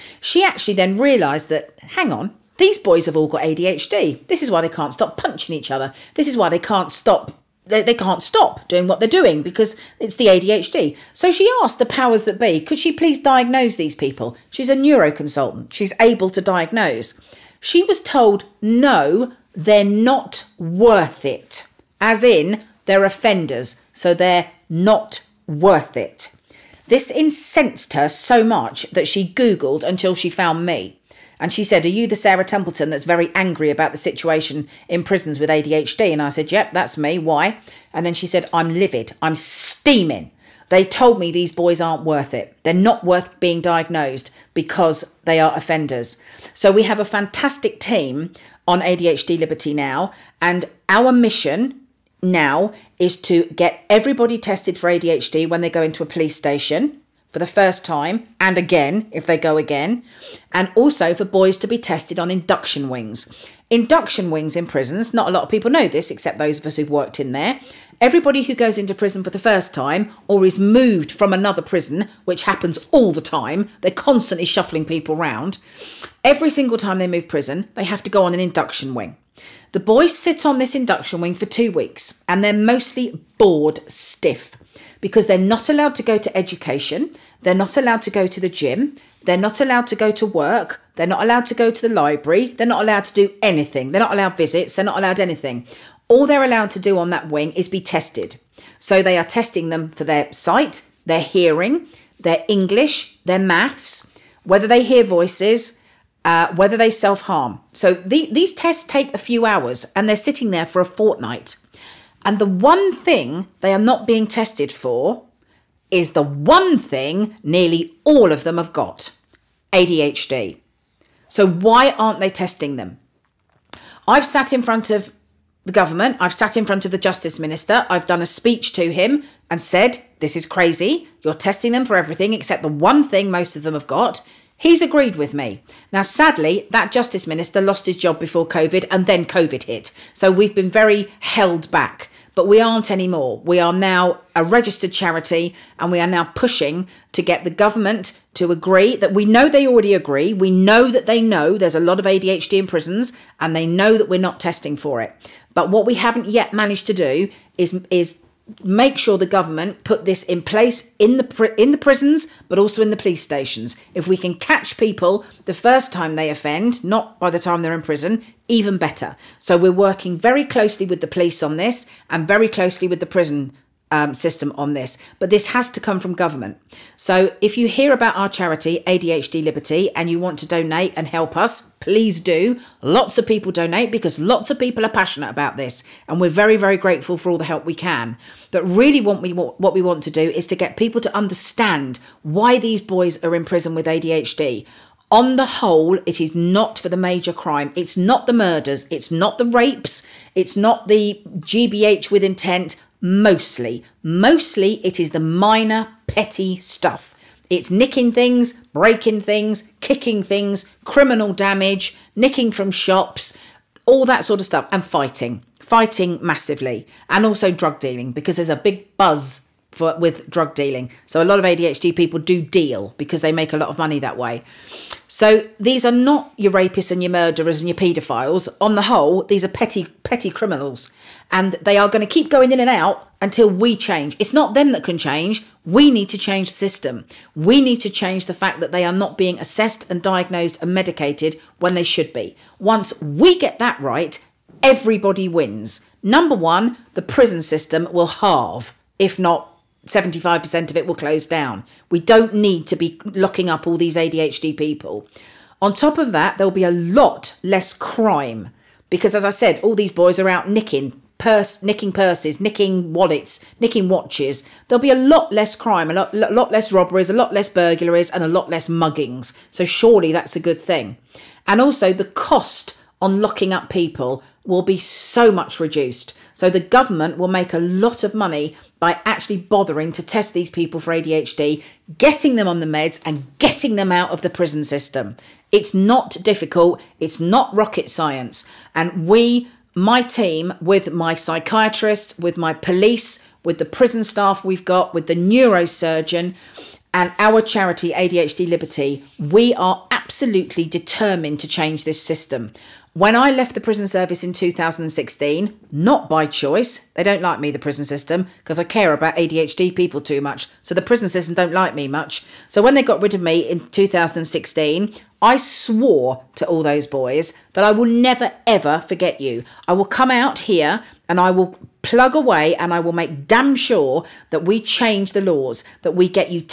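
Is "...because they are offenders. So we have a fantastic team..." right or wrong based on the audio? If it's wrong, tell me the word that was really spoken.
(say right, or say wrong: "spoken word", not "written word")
right.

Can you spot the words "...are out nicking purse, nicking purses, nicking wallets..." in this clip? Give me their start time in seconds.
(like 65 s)
260 s.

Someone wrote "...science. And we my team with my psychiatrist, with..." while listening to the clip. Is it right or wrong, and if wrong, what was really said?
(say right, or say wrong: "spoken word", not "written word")
right.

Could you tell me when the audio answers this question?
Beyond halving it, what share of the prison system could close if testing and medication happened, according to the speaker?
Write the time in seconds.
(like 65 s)
249 s.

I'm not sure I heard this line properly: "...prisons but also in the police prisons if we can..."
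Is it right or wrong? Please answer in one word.
wrong.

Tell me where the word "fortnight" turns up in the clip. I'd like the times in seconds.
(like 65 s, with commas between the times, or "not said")
110 s.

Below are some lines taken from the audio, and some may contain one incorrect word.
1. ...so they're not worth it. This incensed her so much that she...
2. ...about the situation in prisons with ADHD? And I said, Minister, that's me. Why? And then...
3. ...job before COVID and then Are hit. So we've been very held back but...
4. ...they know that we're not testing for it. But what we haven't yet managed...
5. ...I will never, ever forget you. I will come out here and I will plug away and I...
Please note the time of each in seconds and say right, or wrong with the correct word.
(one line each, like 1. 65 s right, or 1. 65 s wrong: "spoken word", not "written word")
1. 23 s right
2. 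33 s wrong: "Yep", not "Minister"
3. 137 s wrong: "COVID", not "Are"
4. 153 s right
5. 317 s right.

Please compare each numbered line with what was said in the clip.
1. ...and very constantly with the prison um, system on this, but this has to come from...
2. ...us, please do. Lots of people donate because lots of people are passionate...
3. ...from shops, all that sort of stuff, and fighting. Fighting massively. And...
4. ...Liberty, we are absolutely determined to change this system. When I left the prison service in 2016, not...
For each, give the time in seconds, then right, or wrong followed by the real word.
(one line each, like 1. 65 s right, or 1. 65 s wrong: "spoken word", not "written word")
1. 172 s wrong: "closely", not "constantly"
2. 181 s right
3. 212 s right
4. 298 s right.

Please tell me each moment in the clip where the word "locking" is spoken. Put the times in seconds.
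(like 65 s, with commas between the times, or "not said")
253 s, 273 s.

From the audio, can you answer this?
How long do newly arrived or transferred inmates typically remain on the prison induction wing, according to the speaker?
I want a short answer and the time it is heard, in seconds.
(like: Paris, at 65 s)
2 weeks, at 81 s.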